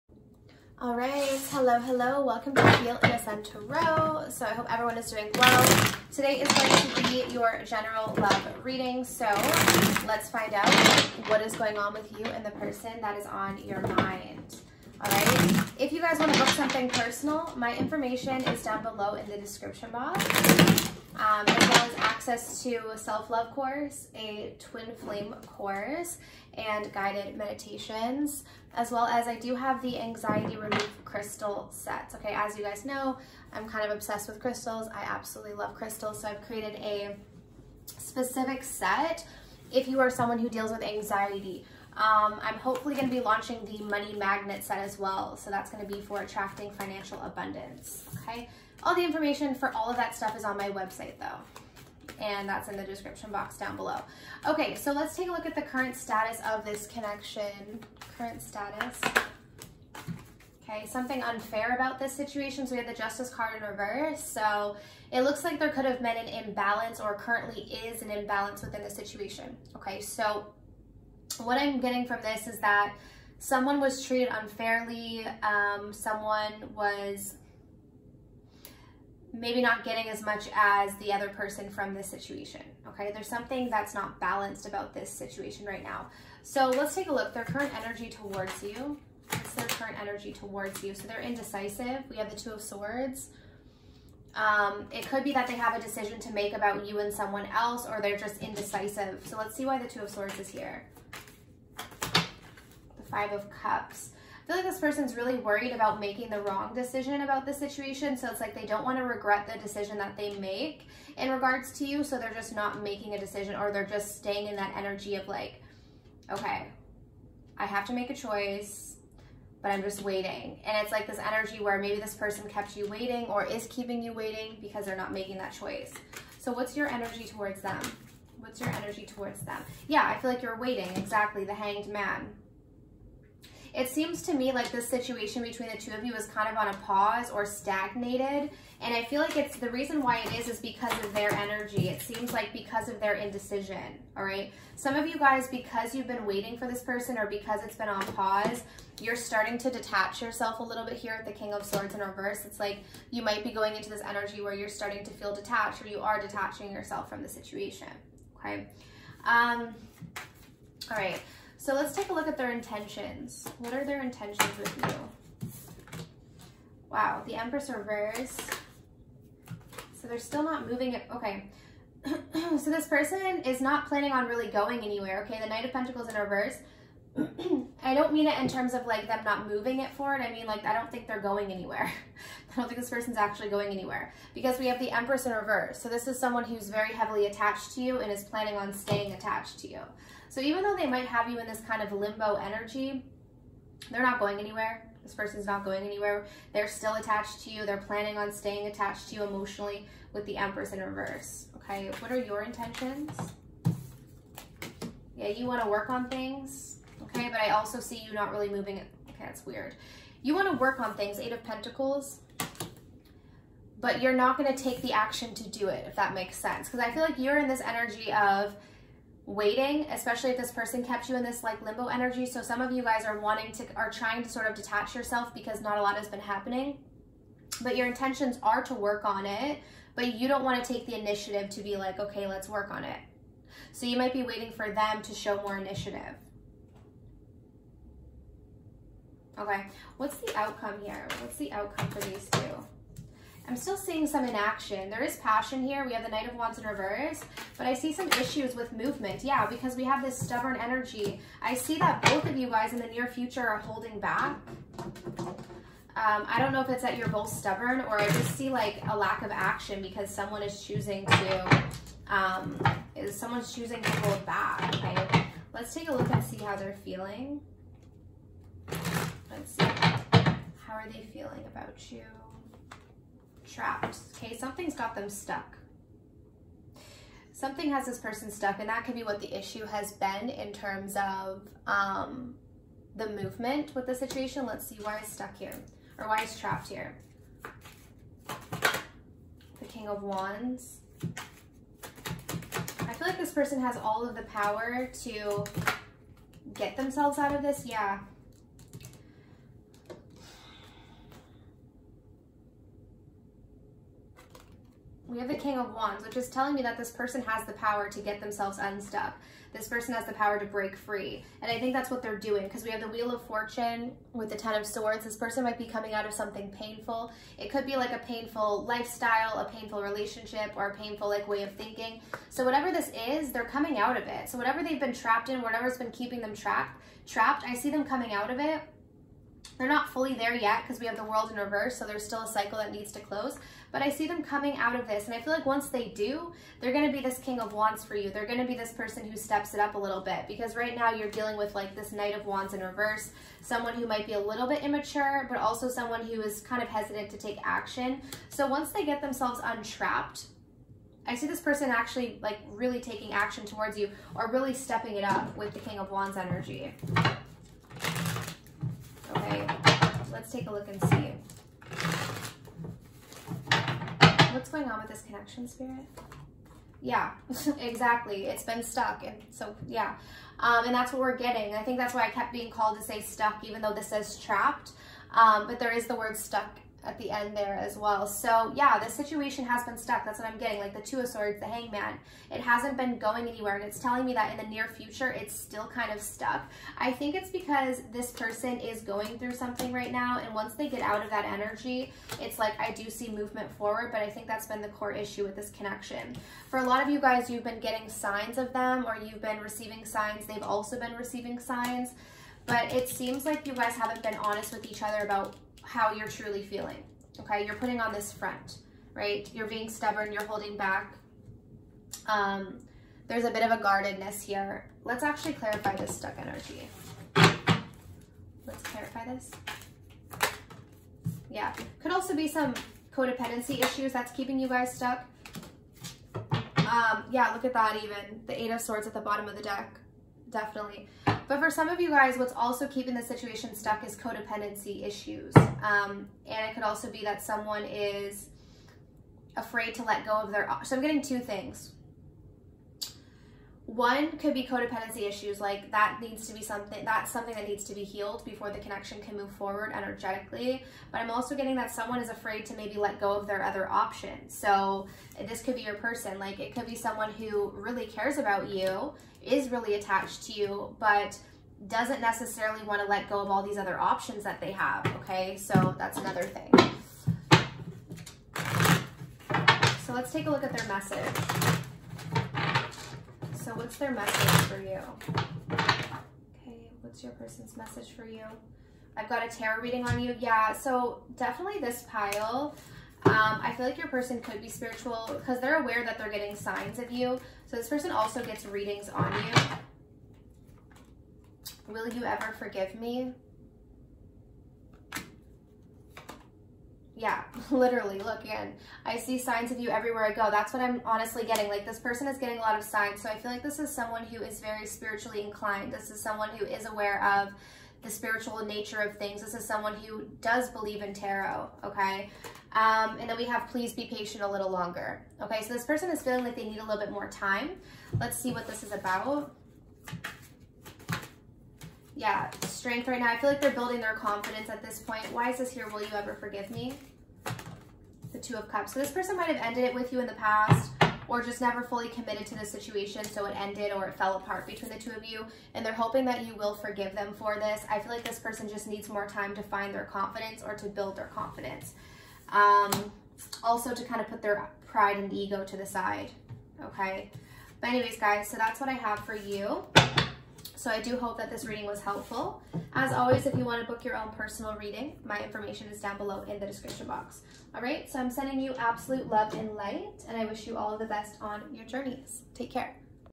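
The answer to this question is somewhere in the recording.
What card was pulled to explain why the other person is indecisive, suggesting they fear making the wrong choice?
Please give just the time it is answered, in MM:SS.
01:43.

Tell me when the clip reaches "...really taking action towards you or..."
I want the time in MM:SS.
05:52.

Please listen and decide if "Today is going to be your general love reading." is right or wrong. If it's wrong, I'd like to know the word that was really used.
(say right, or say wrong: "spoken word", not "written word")
right.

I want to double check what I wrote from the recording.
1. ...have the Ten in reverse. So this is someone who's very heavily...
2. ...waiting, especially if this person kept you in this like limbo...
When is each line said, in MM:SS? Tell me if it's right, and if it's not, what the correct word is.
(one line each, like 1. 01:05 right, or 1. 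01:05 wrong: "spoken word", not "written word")
1. 03:04 wrong: "Empress", not "Ten"
2. 03:39 right.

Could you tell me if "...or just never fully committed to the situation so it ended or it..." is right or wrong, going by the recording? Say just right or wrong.
right.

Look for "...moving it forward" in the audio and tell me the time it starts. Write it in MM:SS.
02:59.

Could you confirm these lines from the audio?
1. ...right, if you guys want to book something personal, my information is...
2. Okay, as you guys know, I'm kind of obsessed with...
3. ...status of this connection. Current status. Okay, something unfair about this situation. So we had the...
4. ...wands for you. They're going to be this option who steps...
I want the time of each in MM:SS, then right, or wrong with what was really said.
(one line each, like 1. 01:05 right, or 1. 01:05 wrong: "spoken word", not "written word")
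1. 00:15 right
2. 00:32 right
3. 00:55 right
4. 05:37 wrong: "person", not "option".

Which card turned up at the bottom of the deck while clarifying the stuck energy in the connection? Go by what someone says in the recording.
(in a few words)
Eight of Swords.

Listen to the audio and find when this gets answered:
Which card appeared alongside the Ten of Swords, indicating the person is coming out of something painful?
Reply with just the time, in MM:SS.
05:12.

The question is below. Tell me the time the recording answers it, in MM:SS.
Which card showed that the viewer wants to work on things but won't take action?
03:31.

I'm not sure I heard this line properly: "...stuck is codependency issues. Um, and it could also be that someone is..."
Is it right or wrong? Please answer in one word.
right.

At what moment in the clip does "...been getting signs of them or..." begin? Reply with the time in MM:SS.
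06:37.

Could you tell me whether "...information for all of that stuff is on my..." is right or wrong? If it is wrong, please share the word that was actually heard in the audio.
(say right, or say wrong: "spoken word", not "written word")
right.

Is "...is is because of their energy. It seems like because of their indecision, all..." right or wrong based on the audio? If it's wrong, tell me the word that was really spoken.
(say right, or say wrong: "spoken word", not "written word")
right.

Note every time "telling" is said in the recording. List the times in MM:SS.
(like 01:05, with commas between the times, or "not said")
05:06, 06:23.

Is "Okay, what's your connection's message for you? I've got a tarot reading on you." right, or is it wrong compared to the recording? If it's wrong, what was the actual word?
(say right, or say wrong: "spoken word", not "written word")
wrong: "person", not "connection".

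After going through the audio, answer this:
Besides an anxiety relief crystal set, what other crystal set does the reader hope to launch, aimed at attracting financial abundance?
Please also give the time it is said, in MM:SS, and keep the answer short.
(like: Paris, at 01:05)
Money magnet set, at 00:43.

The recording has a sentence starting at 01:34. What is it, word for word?
Um, it could be that they have a decision to make about you and someone else, or they're just indecisive.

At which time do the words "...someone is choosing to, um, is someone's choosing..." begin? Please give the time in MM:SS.
04:20.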